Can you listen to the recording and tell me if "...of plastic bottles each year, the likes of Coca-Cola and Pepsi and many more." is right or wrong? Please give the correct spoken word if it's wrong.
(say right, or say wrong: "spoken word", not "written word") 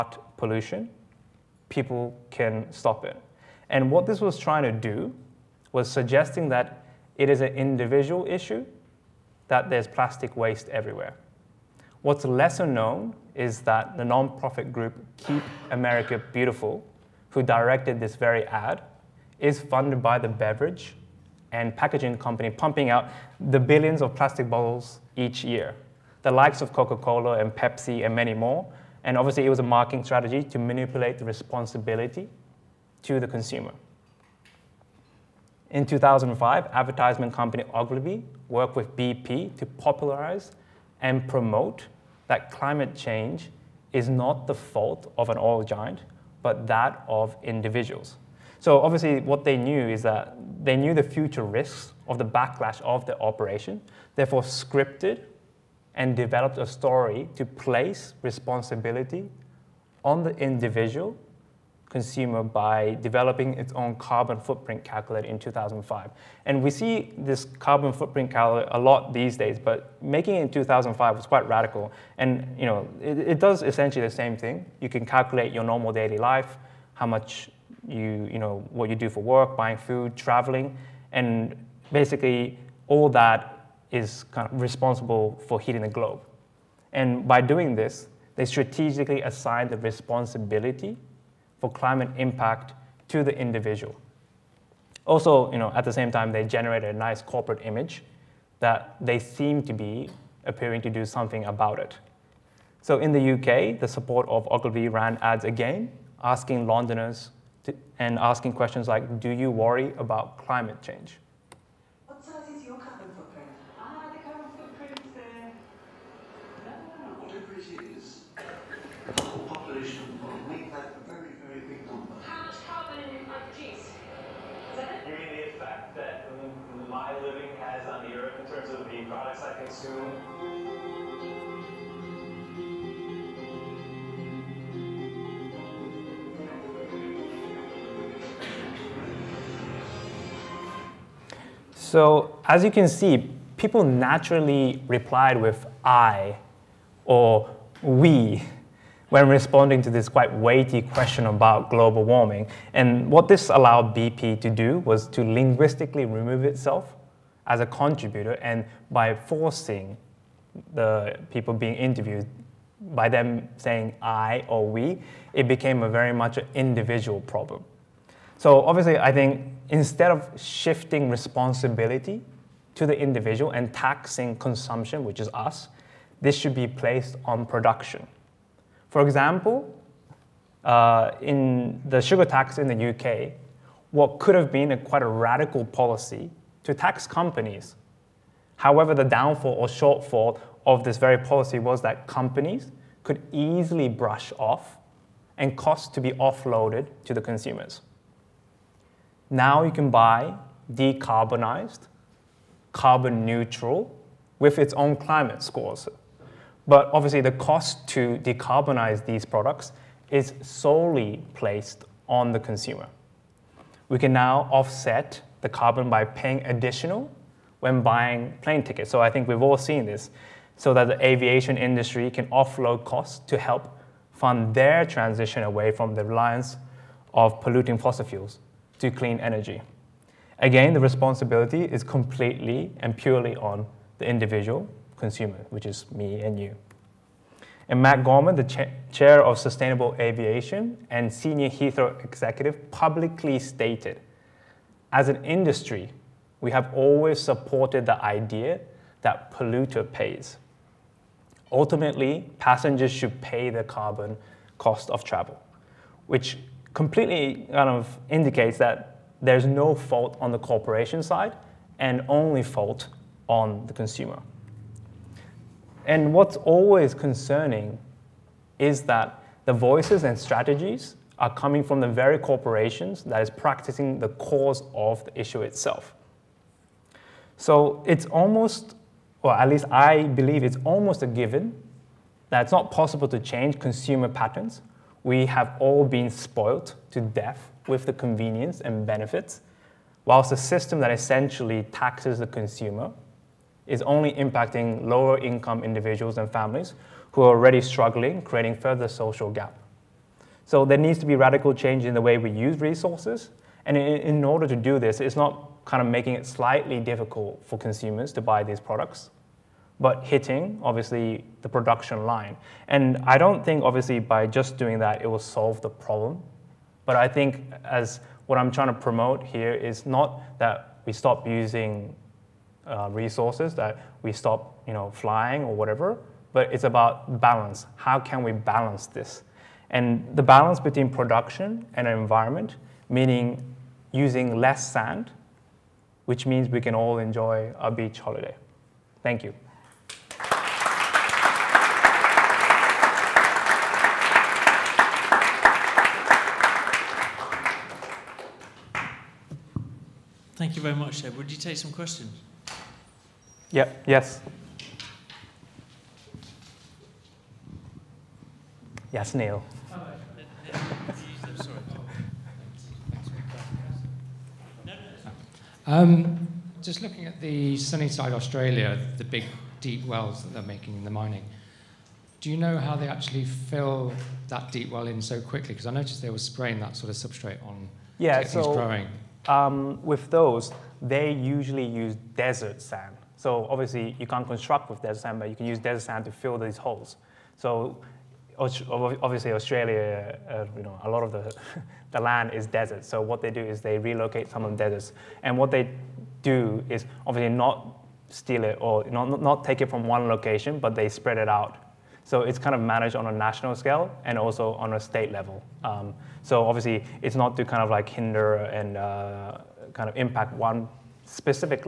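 right.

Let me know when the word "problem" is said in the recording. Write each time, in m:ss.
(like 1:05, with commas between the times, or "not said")
2:47, 5:15.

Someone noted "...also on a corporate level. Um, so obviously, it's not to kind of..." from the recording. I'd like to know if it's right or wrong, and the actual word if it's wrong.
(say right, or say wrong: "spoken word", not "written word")
wrong: "state", not "corporate".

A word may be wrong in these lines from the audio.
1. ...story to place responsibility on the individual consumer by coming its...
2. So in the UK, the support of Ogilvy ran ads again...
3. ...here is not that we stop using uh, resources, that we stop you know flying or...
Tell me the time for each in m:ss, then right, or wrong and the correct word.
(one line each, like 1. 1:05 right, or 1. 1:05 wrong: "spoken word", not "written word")
1. 0:56 wrong: "developing", not "coming"
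2. 1:42 right
3. 5:19 right.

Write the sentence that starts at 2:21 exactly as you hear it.
So as you can see, people naturally replied with I or we when responding to this quite weighty question about global warming.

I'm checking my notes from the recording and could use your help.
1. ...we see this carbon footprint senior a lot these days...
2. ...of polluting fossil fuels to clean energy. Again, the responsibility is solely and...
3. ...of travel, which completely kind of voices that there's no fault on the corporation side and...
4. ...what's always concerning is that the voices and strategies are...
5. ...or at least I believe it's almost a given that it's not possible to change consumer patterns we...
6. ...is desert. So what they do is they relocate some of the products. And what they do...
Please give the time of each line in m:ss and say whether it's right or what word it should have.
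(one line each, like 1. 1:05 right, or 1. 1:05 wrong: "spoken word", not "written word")
1. 1:06 wrong: "calculator", not "senior"
2. 3:47 wrong: "completely", not "solely"
3. 4:14 wrong: "indicates", not "voices"
4. 4:26 right
5. 4:39 right
6. 6:32 wrong: "deserts", not "products".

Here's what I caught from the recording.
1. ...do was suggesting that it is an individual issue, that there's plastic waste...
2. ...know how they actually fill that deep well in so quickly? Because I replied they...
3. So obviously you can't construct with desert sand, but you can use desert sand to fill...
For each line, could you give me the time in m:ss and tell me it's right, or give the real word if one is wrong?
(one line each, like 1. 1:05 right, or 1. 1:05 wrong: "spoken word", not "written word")
1. 0:04 right
2. 6:12 wrong: "noticed", not "replied"
3. 6:23 right.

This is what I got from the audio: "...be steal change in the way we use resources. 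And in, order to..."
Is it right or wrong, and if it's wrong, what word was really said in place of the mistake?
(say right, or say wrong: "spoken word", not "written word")
wrong: "radical", not "steal".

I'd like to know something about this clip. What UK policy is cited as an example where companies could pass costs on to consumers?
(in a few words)
sugar tax.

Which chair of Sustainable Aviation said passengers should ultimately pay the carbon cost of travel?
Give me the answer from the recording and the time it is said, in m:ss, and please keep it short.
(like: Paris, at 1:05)
Matt Gorman, at 3:57.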